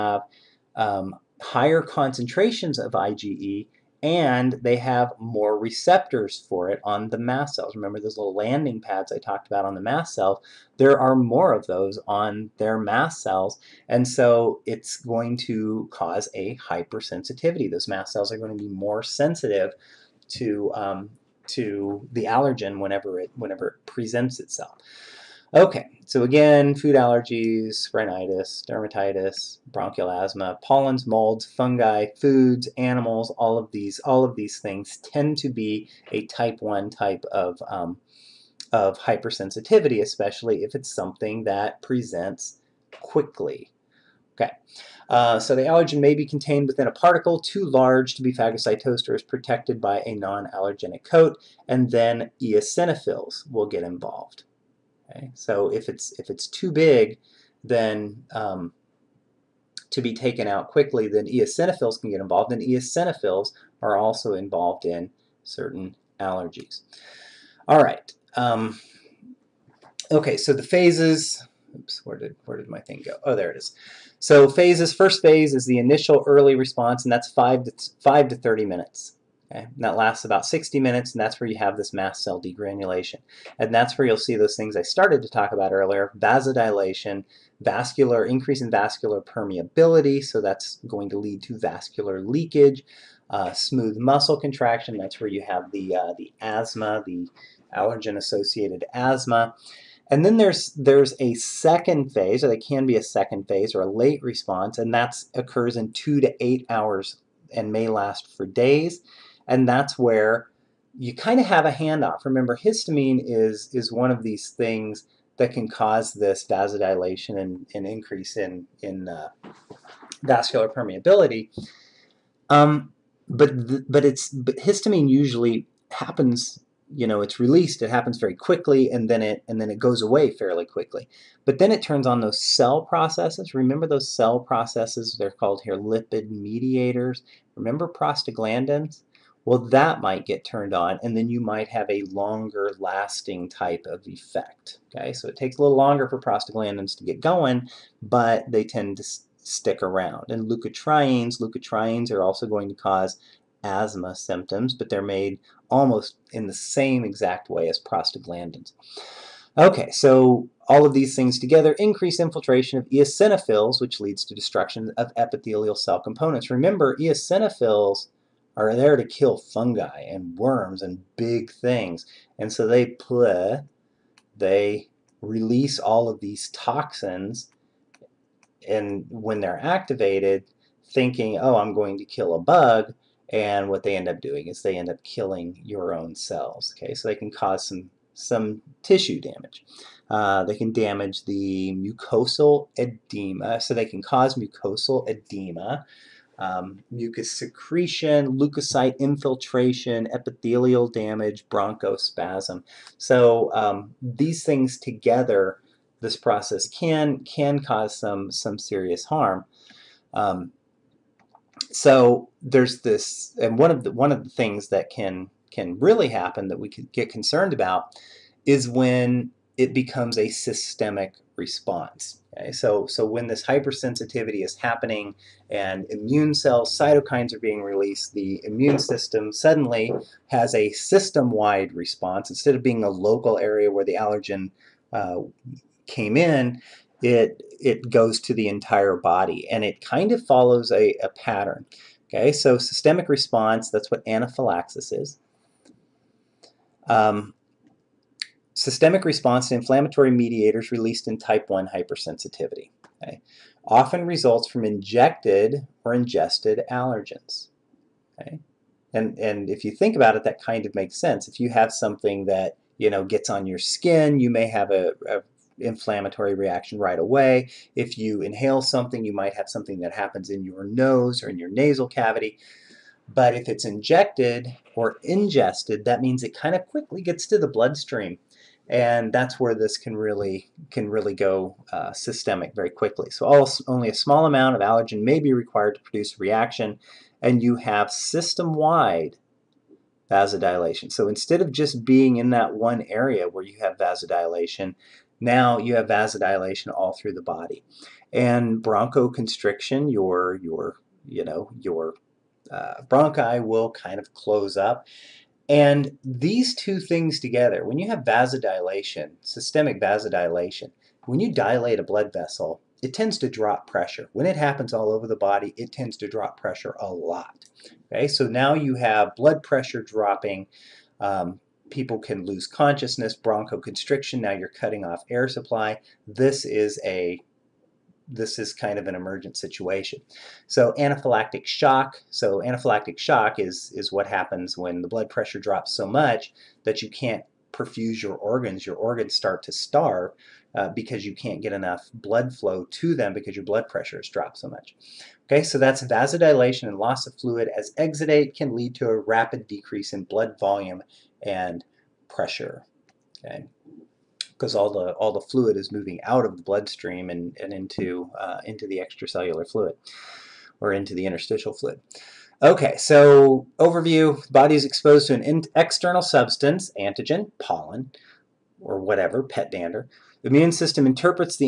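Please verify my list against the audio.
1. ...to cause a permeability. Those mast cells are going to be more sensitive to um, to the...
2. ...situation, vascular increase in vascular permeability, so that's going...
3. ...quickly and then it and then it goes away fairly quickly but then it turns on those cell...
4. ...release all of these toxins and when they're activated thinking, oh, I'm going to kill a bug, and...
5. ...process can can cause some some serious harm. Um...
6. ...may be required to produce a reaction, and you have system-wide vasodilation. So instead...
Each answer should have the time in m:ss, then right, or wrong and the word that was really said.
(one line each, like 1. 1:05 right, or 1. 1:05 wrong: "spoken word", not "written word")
1. 0:15 wrong: "hypersensitivity", not "permeability"
2. 1:26 wrong: "vasodilation", not "situation"
3. 2:08 right
4. 2:55 right
5. 3:26 right
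6. 4:45 right.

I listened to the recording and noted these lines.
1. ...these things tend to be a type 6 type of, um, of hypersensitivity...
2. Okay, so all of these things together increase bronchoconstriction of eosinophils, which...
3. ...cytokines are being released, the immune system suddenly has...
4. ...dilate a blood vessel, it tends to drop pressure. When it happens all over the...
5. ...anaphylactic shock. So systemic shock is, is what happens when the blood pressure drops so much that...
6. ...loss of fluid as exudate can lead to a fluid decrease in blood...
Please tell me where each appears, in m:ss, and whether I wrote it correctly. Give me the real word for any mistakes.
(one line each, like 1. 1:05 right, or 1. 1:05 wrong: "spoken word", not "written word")
1. 0:34 wrong: "1", not "6"
2. 2:39 wrong: "infiltration", not "bronchoconstriction"
3. 3:46 right
4. 5:11 right
5. 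5:30 wrong: "anaphylactic", not "systemic"
6. 5:46 wrong: "rapid", not "fluid".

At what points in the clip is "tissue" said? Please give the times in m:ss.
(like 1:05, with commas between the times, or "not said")
3:08.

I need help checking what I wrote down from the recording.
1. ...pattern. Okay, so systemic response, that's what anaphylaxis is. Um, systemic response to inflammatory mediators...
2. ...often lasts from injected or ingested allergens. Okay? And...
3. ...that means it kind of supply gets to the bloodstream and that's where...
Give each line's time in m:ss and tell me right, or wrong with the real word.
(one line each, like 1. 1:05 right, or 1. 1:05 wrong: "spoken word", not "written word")
1. 4:01 right
2. 4:13 wrong: "results", not "lasts"
3. 4:35 wrong: "quickly", not "supply".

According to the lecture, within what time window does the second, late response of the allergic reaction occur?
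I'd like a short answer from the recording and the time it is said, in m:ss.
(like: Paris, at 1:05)
2 to 8 hours, at 1:45.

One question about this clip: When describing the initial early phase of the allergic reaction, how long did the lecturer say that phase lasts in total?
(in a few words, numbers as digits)
About 60 minutes.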